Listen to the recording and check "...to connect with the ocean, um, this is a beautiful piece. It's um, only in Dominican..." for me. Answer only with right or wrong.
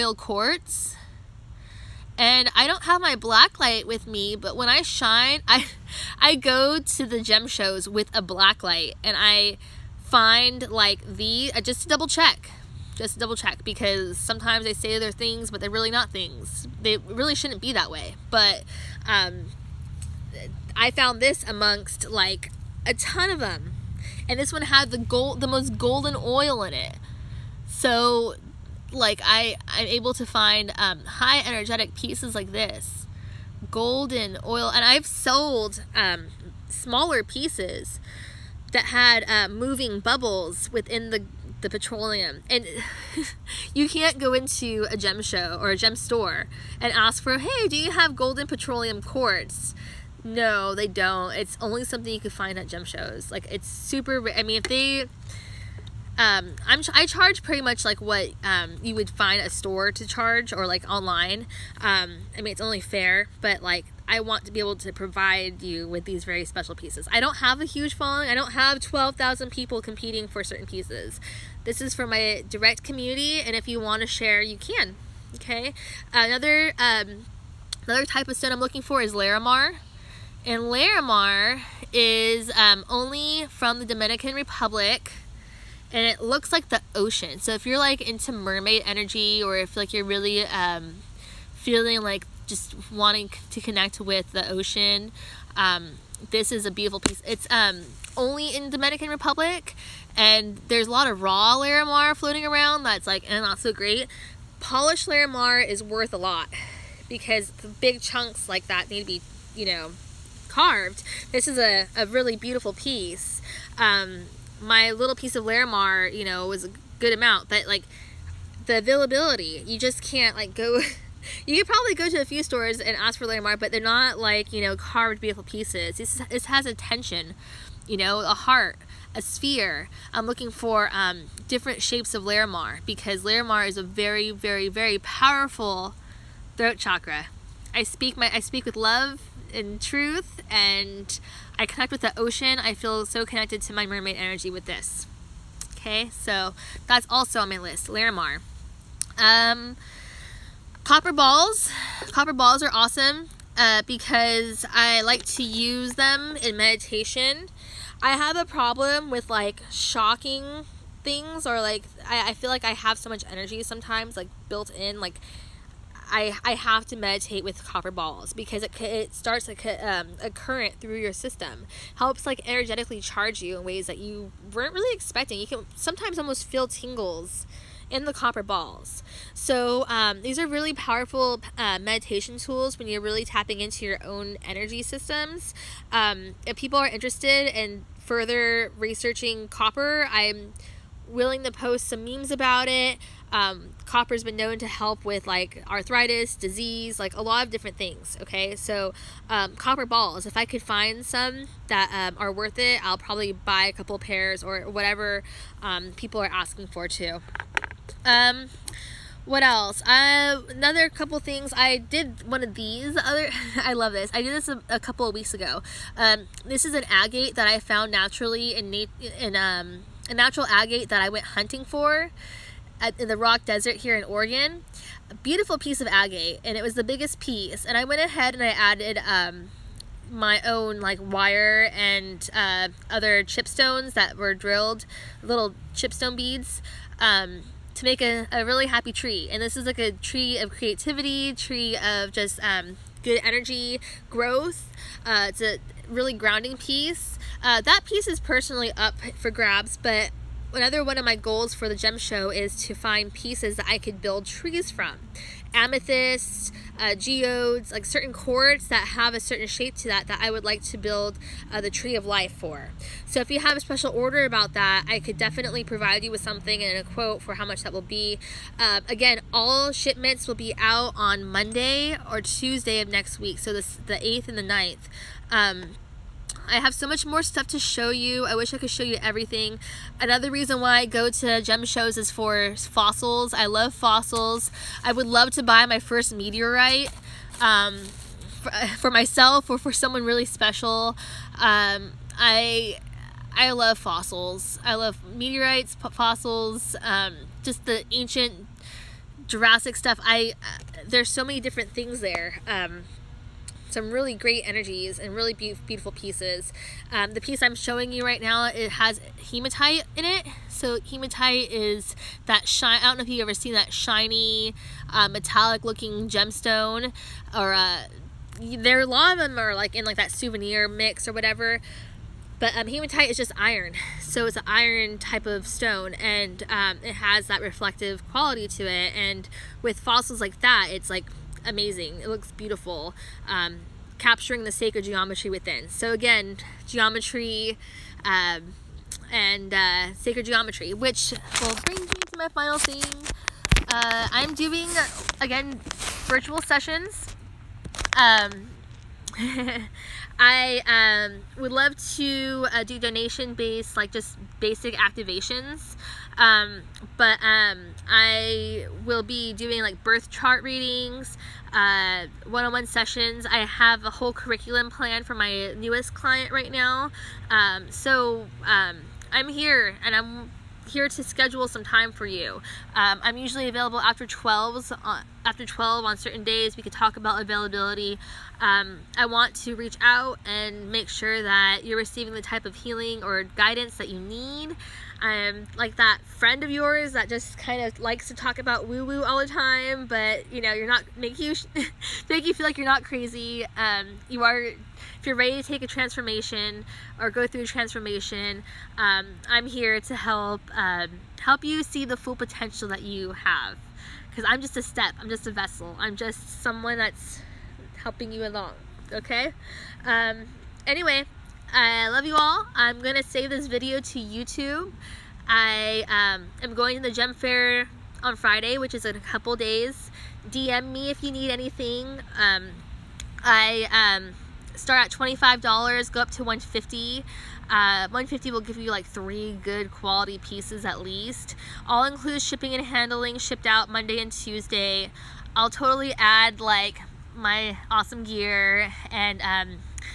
right.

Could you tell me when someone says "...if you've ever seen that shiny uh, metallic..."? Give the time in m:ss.
5:13.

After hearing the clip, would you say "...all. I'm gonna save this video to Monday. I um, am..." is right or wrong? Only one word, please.
wrong.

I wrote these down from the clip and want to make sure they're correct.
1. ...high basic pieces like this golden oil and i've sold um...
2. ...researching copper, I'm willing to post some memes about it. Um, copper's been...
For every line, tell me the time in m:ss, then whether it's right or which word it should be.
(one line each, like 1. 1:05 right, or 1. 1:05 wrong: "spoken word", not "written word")
1. 0:31 wrong: "energetic", not "basic"
2. 3:08 right.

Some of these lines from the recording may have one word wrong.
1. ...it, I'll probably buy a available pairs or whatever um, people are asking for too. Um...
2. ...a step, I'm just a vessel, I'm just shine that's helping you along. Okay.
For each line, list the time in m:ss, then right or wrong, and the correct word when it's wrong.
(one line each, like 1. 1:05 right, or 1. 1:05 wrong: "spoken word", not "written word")
1. 3:22 wrong: "couple", not "available"
2. 6:44 wrong: "someone", not "shine".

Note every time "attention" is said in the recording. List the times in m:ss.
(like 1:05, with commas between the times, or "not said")
2:06.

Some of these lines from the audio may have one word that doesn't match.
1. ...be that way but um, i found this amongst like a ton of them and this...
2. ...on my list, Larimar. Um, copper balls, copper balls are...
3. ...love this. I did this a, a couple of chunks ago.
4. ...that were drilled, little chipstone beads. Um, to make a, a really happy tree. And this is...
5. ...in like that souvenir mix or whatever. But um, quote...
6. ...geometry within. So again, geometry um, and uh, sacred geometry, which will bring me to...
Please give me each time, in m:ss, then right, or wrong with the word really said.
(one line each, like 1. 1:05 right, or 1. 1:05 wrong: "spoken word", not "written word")
1. 0:17 right
2. 2:27 right
3. 3:33 wrong: "weeks", not "chunks"
4. 3:53 right
5. 5:19 wrong: "hematite", not "quote"
6. 5:34 right.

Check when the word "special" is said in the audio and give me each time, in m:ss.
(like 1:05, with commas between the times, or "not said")
1:06, 4:23, 4:50.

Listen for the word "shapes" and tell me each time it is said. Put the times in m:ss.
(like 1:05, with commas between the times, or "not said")
2:11, 4:19.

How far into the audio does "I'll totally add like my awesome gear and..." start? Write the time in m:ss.
7:15.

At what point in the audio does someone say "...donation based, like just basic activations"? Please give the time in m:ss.
5:52.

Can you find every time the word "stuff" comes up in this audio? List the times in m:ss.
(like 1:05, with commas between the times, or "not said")
4:37, 4:59.